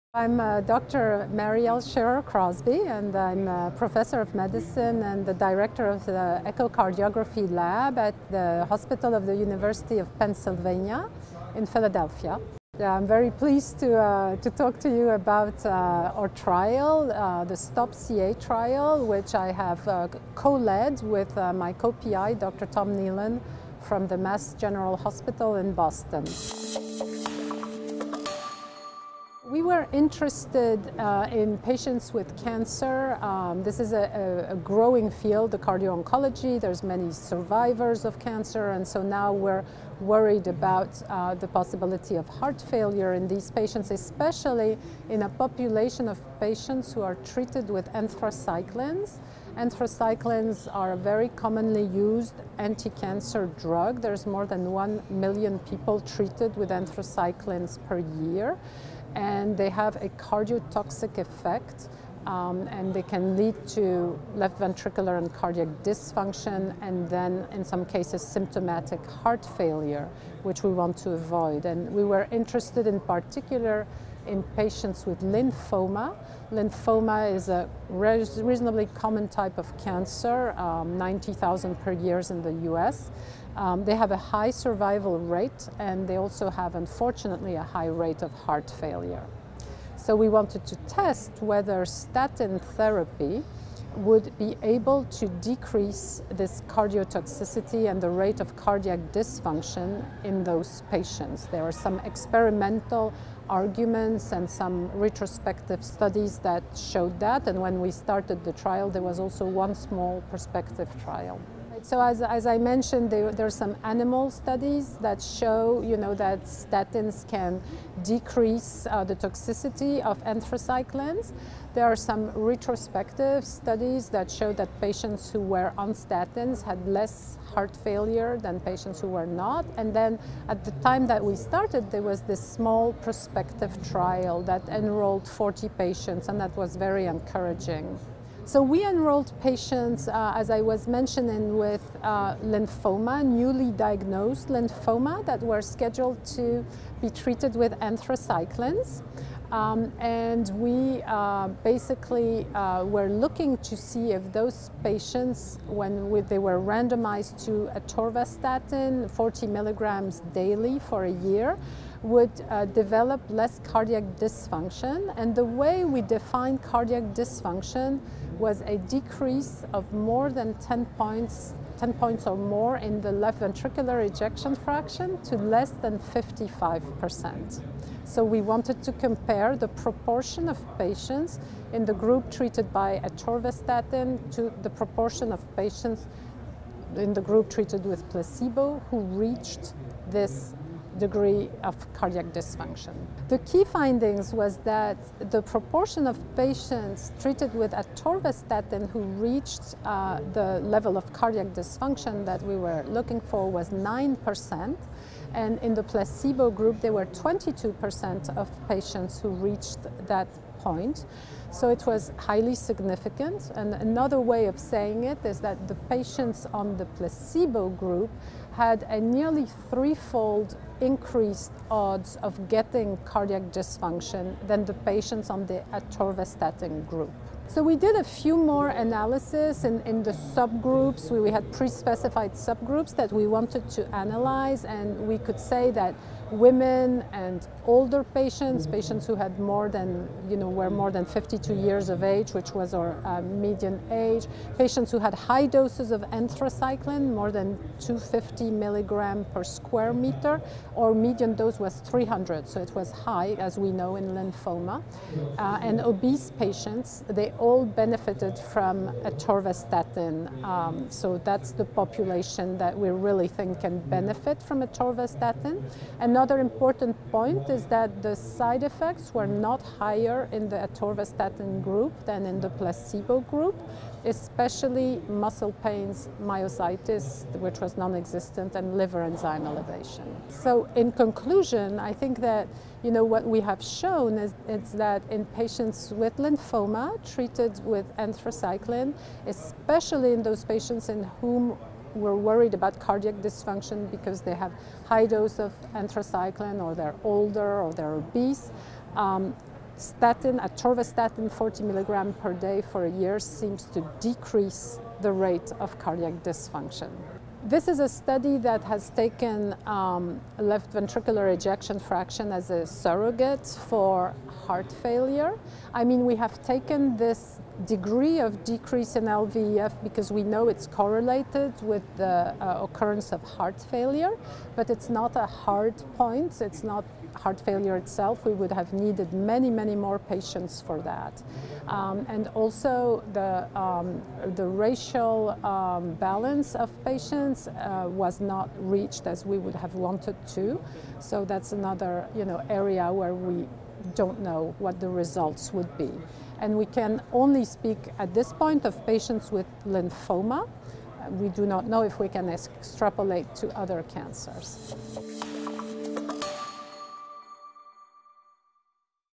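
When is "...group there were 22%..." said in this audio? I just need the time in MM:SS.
03:26.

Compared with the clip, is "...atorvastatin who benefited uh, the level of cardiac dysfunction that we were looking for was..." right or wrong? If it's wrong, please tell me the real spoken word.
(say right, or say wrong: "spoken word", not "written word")
wrong: "reached", not "benefited".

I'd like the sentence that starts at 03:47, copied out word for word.
So we did a few more analysis in, in the subgroups.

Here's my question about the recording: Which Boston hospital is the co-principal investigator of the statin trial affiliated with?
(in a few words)
Mass General Hospital.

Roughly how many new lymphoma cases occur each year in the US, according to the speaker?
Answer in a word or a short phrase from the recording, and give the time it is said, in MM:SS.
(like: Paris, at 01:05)
90,000, at 01:20.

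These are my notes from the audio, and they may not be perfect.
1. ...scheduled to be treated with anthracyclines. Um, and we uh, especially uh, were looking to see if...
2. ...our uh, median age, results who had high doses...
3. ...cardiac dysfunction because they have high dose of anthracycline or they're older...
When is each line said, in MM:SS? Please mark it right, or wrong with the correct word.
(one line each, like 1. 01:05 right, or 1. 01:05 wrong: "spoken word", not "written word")
1. 02:25 wrong: "basically", not "especially"
2. 04:02 wrong: "patients", not "results"
3. 04:52 right.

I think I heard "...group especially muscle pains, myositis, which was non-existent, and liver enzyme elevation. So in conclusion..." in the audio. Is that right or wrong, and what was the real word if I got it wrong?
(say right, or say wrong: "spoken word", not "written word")
right.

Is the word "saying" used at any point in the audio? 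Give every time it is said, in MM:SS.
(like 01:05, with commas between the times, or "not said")
03:34.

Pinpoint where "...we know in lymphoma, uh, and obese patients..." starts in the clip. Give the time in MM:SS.
04:13.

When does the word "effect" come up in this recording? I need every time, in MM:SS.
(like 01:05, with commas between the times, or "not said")
01:01, 04:28.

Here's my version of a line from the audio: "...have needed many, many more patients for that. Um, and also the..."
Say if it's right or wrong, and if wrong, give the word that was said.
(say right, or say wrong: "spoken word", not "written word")
right.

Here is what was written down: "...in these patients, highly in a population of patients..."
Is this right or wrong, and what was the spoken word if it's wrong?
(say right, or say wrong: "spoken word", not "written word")
wrong: "especially", not "highly".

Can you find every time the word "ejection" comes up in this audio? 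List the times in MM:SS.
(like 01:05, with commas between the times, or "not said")
02:54, 05:11.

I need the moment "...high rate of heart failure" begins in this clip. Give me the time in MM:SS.
01:27.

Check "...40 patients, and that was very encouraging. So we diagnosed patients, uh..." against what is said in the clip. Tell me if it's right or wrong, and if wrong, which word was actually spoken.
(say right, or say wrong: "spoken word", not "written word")
wrong: "enrolled", not "diagnosed".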